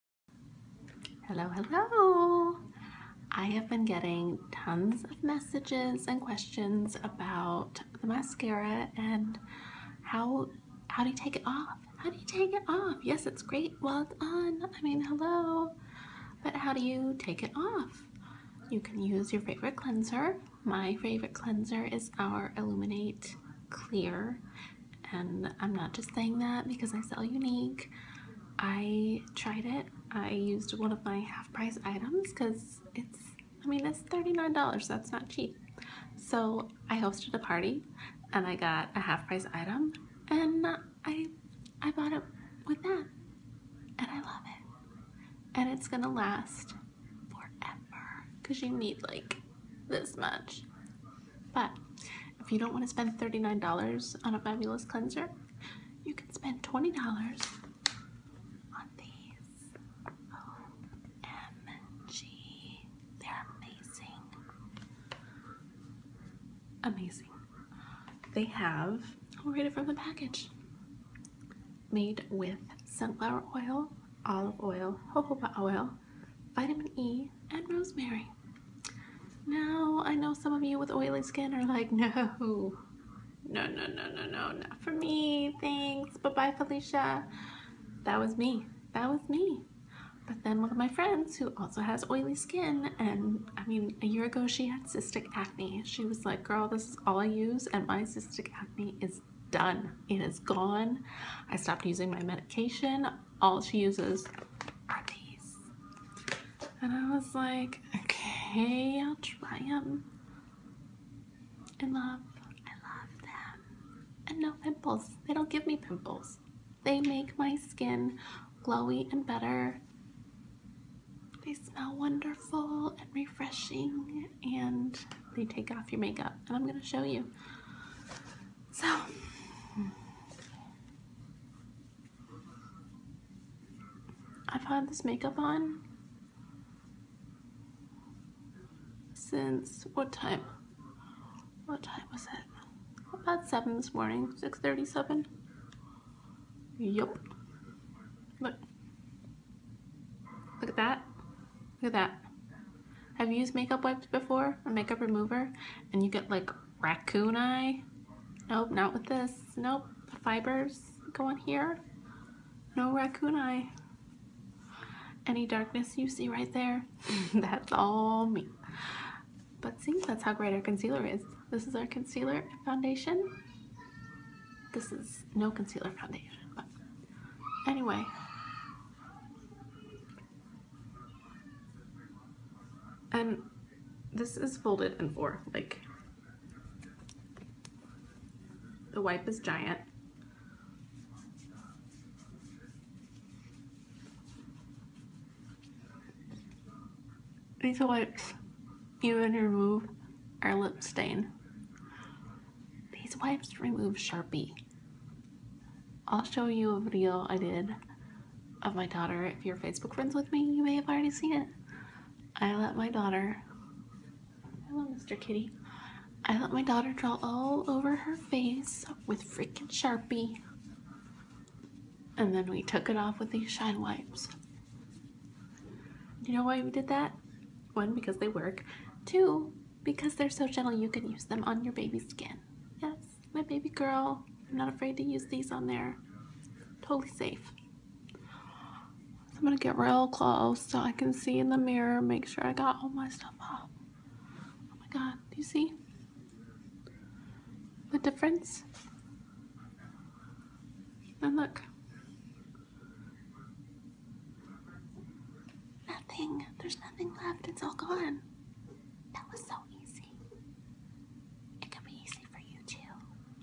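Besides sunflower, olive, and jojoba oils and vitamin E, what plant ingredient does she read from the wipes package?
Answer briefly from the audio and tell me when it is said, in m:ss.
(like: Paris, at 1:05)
rosemary, at 1:17.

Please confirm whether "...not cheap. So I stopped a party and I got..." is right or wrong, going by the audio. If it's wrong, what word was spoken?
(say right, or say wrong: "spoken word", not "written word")
wrong: "hosted", not "stopped".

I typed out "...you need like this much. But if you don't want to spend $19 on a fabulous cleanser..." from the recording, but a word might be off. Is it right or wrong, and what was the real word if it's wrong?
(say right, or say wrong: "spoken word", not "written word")
wrong: "39", not "19".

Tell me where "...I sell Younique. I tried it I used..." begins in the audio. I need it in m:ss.
0:26.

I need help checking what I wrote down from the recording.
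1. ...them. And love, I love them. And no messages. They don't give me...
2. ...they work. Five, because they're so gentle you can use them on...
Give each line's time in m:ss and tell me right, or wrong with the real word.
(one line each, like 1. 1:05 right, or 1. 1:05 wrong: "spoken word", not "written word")
1. 1:49 wrong: "pimples", not "messages"
2. 3:48 wrong: "Two", not "Five".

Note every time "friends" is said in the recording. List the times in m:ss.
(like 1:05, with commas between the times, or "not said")
1:30, 3:29.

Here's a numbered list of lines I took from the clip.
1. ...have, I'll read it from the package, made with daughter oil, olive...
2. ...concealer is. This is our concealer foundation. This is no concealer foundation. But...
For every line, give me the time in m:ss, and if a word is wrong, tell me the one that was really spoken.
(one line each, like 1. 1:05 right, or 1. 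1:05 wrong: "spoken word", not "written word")
1. 1:08 wrong: "sunflower", not "daughter"
2. 2:50 right.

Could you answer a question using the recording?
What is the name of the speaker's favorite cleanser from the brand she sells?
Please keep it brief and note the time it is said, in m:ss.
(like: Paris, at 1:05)
Illuminate Clear, at 0:22.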